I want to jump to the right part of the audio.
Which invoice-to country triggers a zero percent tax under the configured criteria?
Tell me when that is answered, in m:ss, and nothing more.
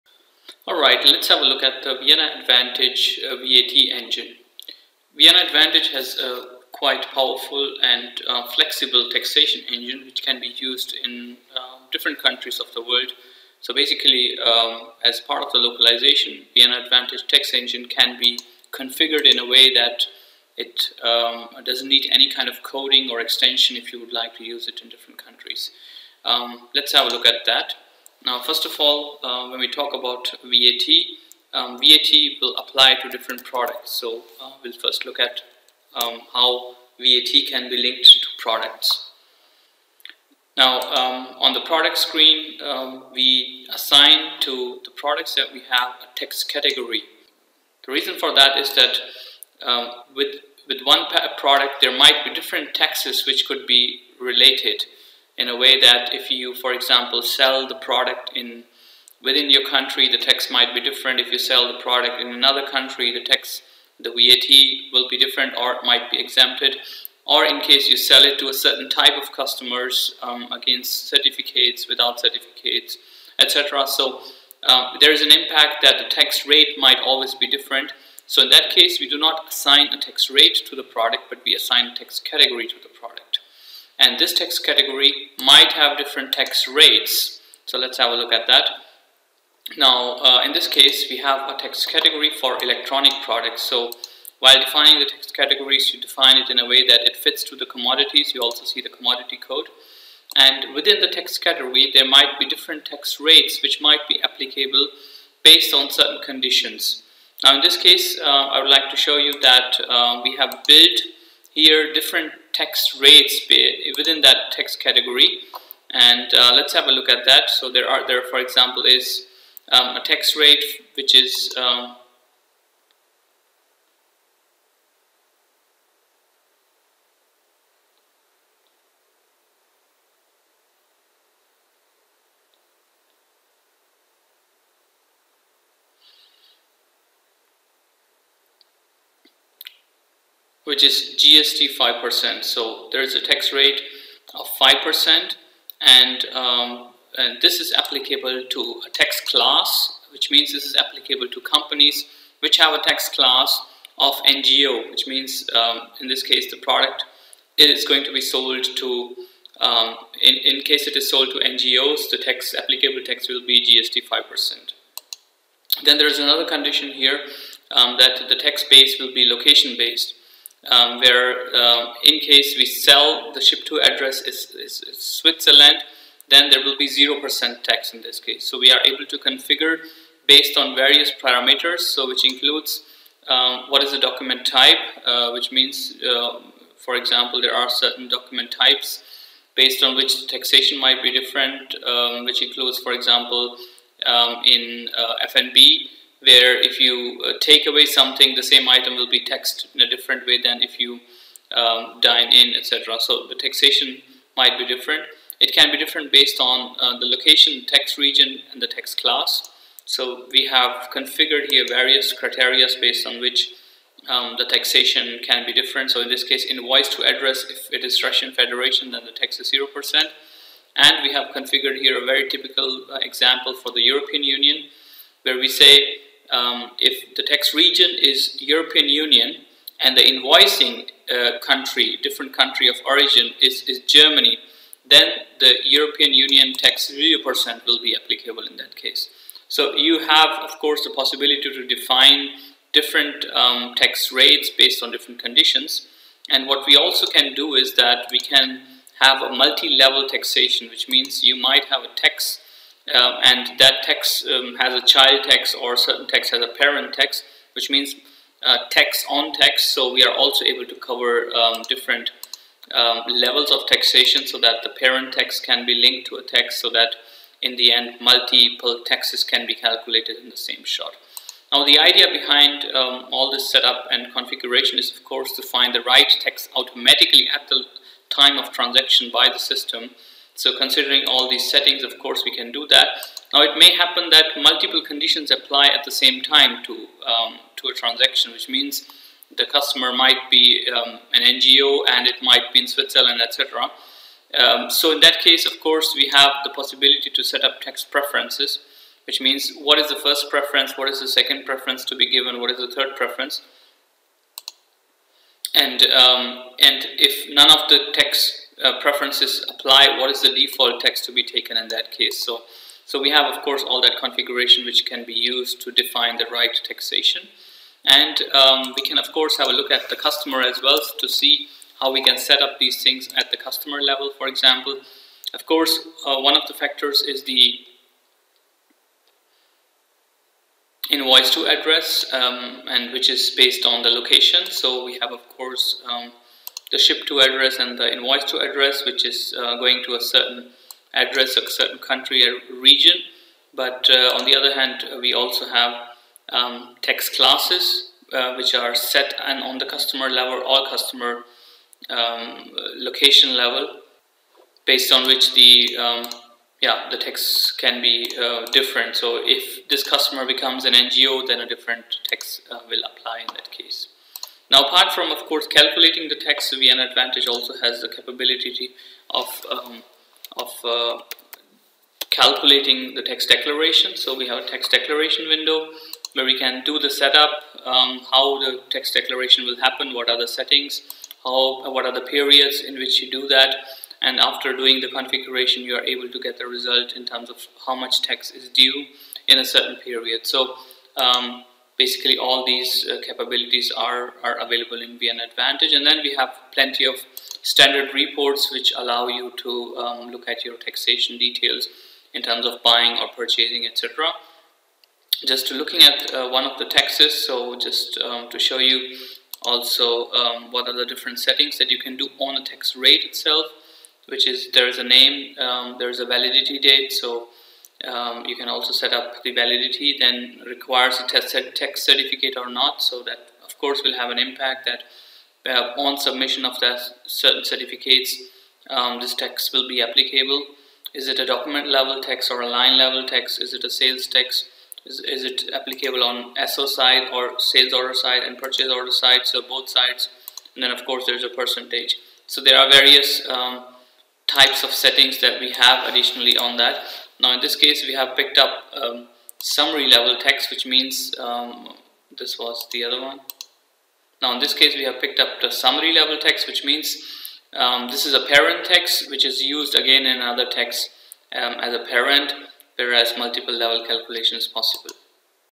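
3:38.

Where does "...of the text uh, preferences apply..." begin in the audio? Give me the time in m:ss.
5:07.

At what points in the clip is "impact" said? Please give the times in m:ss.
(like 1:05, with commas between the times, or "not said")
1:15, 7:04.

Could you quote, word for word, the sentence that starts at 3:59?
So you have, of course, the possibility to define different um, tax rates based on different conditions.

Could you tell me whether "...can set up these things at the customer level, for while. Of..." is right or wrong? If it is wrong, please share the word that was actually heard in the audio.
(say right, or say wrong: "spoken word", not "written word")
wrong: "example", not "while".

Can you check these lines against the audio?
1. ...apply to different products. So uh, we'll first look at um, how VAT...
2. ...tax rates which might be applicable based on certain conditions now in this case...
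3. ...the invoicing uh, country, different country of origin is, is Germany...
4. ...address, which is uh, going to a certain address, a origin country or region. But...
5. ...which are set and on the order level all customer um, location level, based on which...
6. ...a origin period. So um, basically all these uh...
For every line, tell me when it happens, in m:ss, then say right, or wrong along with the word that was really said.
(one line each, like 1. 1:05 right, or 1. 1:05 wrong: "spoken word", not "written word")
1. 0:32 right
2. 1:42 right
3. 3:49 right
4. 5:38 wrong: "certain", not "origin"
5. 5:48 wrong: "customer", not "order"
6. 6:29 wrong: "certain", not "origin".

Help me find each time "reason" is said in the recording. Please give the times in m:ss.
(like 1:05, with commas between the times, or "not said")
0:47.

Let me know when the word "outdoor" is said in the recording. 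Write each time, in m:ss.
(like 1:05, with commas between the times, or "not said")
not said.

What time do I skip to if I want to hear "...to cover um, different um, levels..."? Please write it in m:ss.
4:20.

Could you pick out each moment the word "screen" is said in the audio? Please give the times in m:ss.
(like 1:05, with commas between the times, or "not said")
0:41.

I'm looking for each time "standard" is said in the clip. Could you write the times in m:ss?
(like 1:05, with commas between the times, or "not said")
6:37.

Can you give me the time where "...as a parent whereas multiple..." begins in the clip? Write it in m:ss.
7:41.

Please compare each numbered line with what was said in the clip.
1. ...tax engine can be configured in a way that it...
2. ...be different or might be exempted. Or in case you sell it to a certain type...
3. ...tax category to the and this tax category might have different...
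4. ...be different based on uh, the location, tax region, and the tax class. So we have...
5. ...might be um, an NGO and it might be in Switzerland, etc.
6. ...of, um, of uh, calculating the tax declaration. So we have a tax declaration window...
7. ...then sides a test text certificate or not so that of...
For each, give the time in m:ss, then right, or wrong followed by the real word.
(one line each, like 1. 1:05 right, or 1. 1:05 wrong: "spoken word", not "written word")
1. 0:17 right
2. 1:05 right
3. 1:21 right
4. 3:25 right
5. 4:49 right
6. 6:09 right
7. 6:59 wrong: "requires", not "sides".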